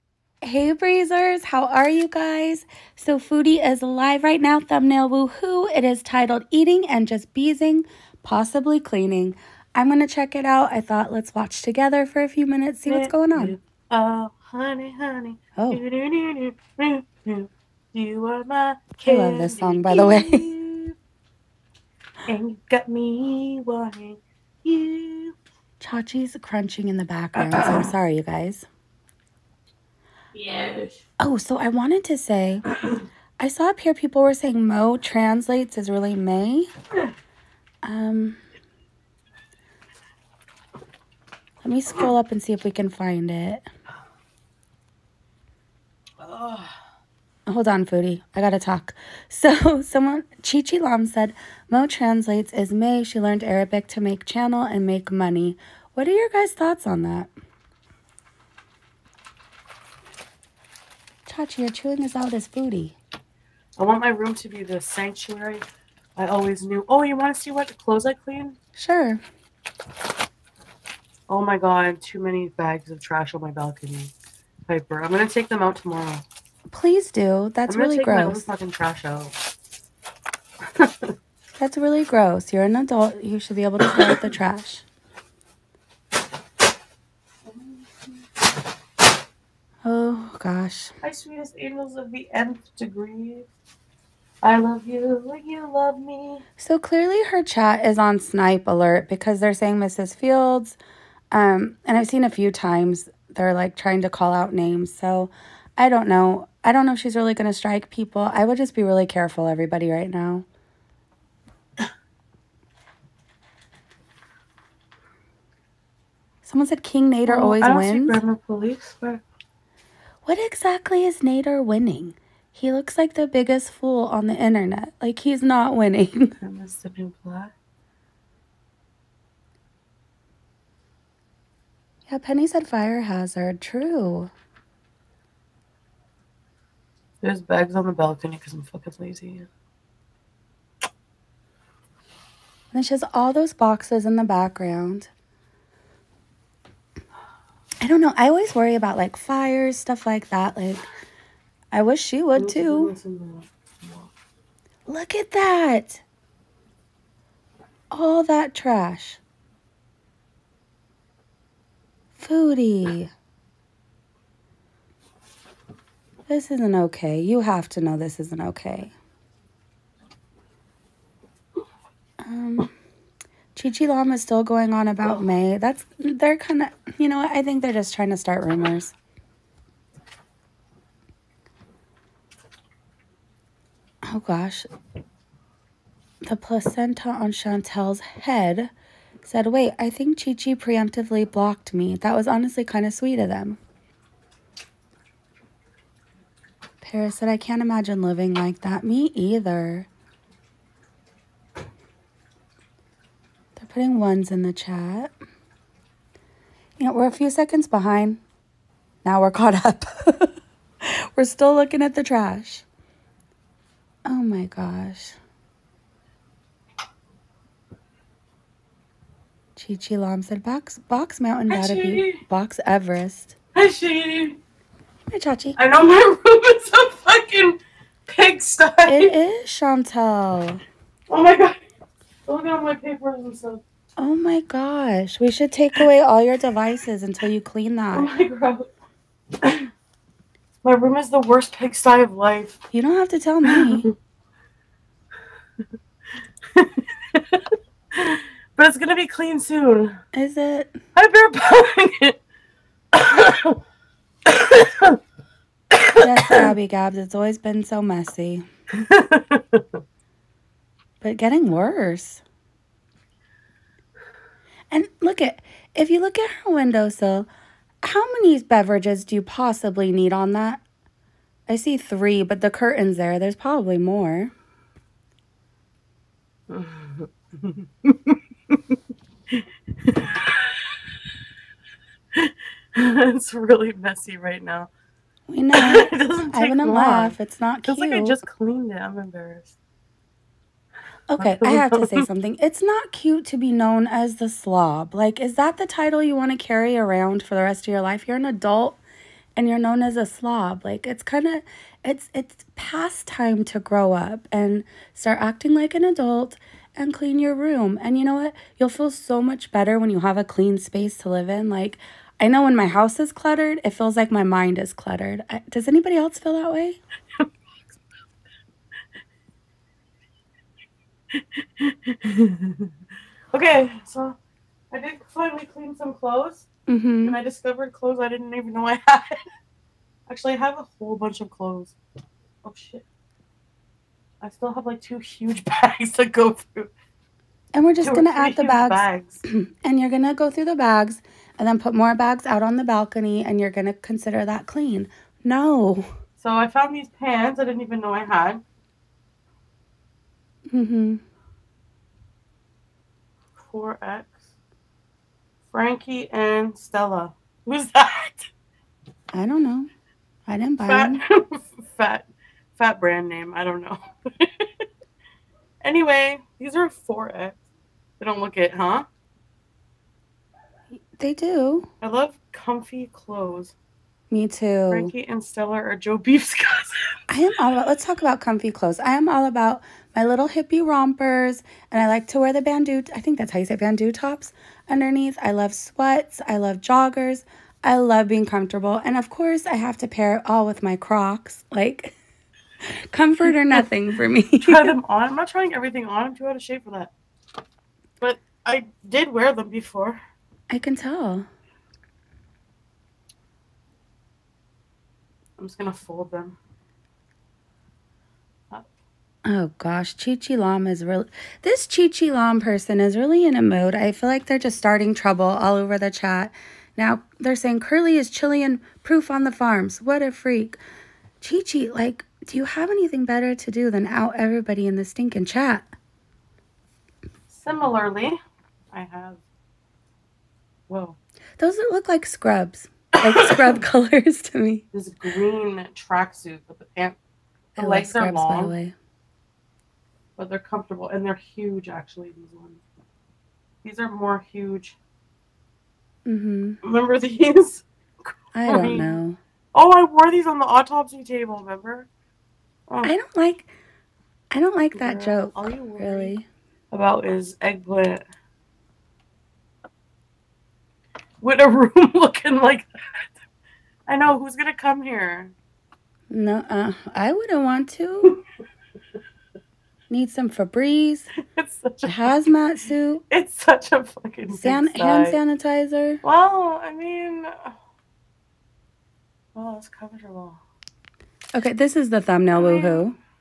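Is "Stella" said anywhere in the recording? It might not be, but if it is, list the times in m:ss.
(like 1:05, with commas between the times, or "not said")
5:56, 6:15.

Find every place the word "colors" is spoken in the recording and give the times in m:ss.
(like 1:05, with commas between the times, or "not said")
7:13.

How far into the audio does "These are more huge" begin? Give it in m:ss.
7:23.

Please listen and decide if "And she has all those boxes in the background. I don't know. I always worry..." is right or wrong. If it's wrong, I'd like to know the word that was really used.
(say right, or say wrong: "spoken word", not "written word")
right.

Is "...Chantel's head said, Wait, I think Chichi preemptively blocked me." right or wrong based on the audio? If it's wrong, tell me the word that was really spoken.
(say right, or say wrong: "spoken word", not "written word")
right.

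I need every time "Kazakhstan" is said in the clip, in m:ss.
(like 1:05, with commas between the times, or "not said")
not said.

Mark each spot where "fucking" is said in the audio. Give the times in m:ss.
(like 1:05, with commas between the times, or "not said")
1:18, 2:18, 3:46, 7:53.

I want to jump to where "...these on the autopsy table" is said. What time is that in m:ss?
7:30.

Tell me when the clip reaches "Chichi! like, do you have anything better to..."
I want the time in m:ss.
7:01.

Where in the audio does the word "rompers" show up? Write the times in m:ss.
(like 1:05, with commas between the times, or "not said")
6:20.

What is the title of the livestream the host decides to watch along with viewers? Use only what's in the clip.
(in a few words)
Eating and Just Beezing, Possibly Cleaning.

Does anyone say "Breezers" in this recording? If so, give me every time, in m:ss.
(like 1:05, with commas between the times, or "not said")
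0:00.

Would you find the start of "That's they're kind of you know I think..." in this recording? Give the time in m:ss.
2:55.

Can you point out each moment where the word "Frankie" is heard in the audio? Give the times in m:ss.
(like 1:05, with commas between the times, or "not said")
5:55, 6:14.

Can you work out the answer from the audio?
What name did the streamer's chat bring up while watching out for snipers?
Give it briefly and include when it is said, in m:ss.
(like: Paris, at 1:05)
Mrs. Fields, at 1:39.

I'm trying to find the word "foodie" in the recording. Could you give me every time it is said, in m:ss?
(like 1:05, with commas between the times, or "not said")
0:03, 0:47, 1:02, 2:42.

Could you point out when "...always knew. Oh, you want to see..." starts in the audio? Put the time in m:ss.
1:06.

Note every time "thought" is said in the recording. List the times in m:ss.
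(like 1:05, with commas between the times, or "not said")
0:10, 0:56.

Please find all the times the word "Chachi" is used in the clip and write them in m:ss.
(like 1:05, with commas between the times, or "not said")
0:25, 3:45.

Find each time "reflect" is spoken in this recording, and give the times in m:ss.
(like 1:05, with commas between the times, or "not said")
not said.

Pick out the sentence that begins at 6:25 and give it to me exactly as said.
I love sweats, I love joggers, I love being comfortable.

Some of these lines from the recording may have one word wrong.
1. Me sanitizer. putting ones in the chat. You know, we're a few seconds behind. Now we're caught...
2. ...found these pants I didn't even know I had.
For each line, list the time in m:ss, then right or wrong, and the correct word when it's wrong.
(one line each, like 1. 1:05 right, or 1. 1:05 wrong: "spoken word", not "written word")
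1. 3:18 wrong: "either", not "sanitizer"
2. 5:46 right.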